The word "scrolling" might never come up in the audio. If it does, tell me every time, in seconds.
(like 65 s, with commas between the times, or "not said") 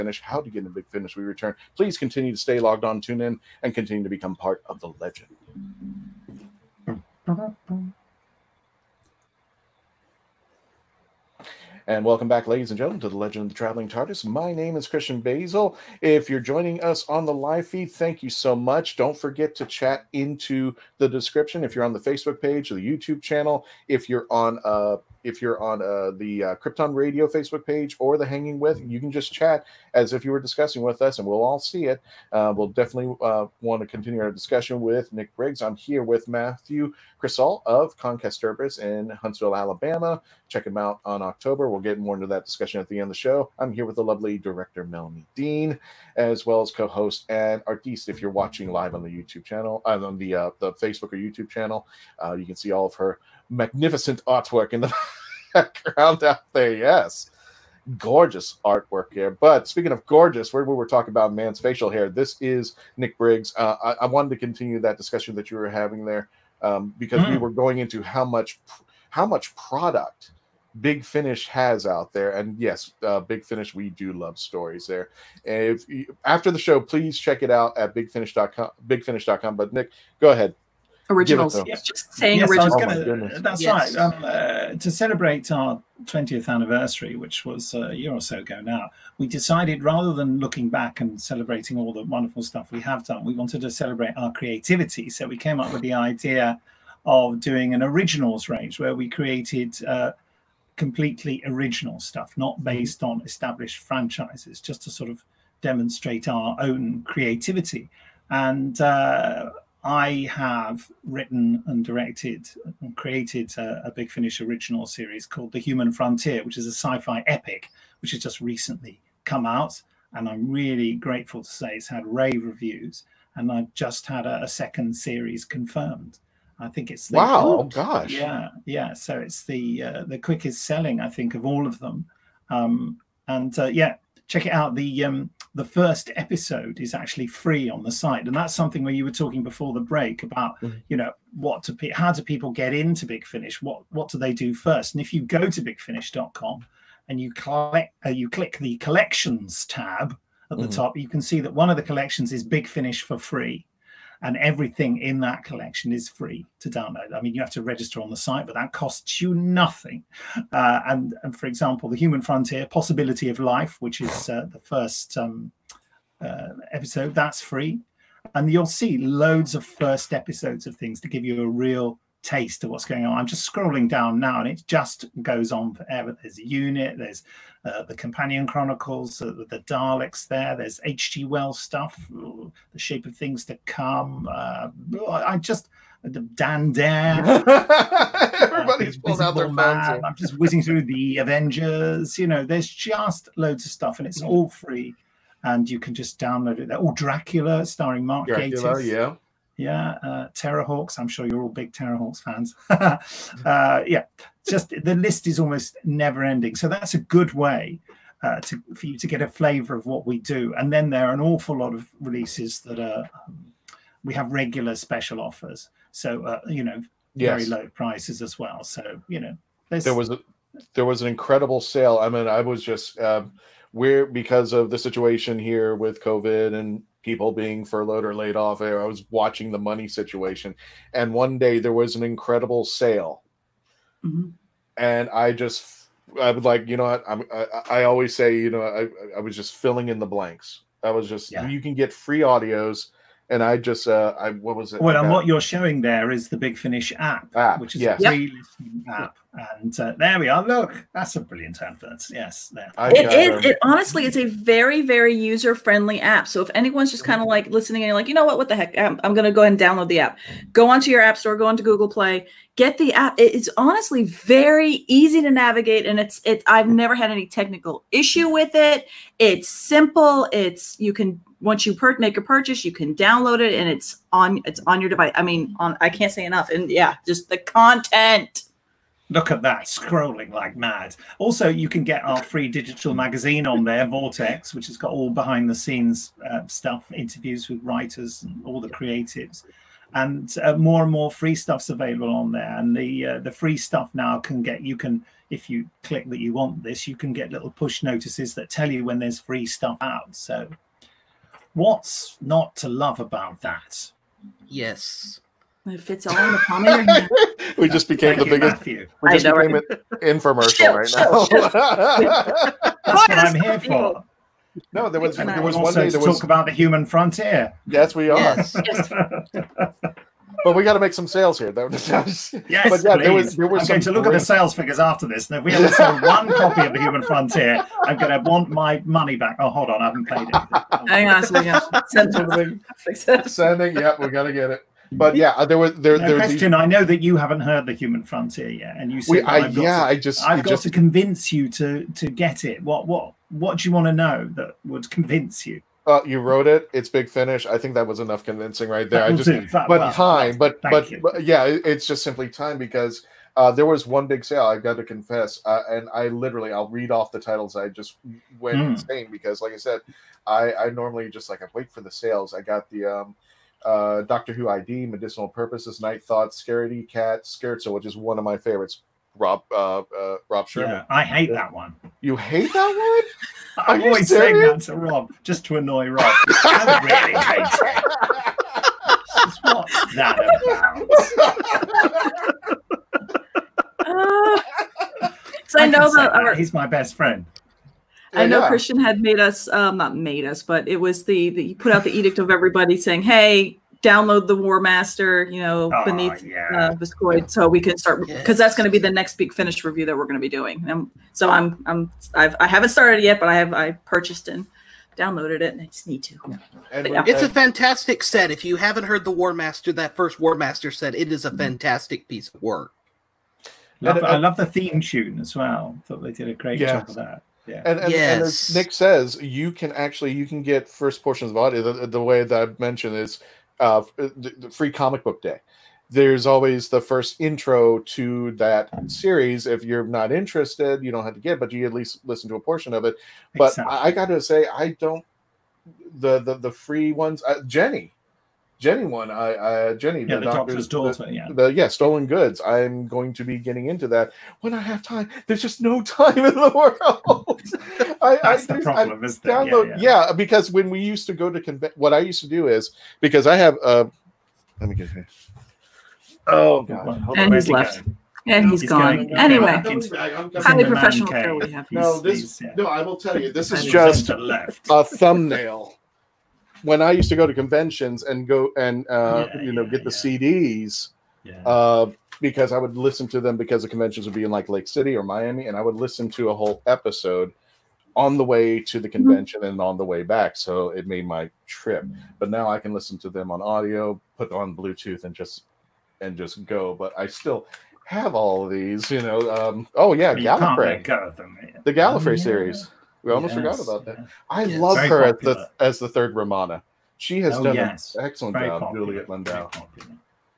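173 s, 279 s.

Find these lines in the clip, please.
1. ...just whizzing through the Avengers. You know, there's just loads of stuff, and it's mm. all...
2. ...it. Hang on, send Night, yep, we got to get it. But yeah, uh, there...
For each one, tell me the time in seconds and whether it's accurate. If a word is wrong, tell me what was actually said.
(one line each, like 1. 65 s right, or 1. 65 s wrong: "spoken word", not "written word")
1. 190 s right
2. 330 s wrong: "Sending", not "Night".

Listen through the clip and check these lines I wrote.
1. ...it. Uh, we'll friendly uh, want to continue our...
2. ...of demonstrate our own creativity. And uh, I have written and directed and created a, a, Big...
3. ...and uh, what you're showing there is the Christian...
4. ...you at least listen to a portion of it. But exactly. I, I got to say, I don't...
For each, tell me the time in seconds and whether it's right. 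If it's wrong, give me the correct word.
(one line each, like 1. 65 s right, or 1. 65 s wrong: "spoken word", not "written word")
1. 31 s wrong: "definitely", not "friendly"
2. 105 s right
3. 244 s wrong: "Big", not "Christian"
4. 431 s right.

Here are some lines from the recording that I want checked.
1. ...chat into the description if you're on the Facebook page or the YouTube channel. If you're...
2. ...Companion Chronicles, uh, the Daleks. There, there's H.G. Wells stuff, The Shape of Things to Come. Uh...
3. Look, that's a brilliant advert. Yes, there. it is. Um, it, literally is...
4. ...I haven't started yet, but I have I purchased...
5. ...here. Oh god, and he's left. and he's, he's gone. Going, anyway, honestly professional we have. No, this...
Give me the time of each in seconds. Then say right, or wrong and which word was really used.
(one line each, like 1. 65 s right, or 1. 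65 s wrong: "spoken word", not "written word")
1. 19 s right
2. 177 s right
3. 250 s wrong: "honestly", not "literally"
4. 402 s right
5. 454 s wrong: "highly", not "honestly".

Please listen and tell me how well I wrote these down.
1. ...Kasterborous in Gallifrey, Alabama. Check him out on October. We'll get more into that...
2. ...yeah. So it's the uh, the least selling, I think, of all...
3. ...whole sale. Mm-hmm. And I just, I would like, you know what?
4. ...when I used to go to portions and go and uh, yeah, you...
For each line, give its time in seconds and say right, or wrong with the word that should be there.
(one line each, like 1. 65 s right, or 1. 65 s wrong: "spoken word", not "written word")
1. 38 s wrong: "Huntsville", not "Gallifrey"
2. 128 s wrong: "quickest", not "least"
3. 232 s wrong: "incredible", not "whole"
4. 466 s wrong: "conventions", not "portions".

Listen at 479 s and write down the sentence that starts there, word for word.
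convention and on the way back.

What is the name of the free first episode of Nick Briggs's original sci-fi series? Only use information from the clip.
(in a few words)
Possibility of Life.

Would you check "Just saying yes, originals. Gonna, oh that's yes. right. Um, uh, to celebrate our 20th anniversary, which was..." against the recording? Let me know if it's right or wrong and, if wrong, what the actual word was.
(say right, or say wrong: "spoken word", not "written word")
right.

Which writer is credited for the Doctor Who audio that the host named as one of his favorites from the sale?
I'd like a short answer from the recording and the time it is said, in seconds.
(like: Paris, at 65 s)
Rob Shearman, at 370 s.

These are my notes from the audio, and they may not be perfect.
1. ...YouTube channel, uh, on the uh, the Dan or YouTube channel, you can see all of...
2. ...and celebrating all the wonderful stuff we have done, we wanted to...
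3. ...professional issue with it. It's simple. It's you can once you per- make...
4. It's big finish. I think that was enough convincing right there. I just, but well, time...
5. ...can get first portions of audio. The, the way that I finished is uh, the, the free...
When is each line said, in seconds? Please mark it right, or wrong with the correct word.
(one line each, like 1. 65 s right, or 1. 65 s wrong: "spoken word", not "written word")
1. 49 s wrong: "Facebook", not "Dan"
2. 90 s right
3. 267 s wrong: "technical", not "professional"
4. 346 s right
5. 420 s wrong: "mentioned", not "finished".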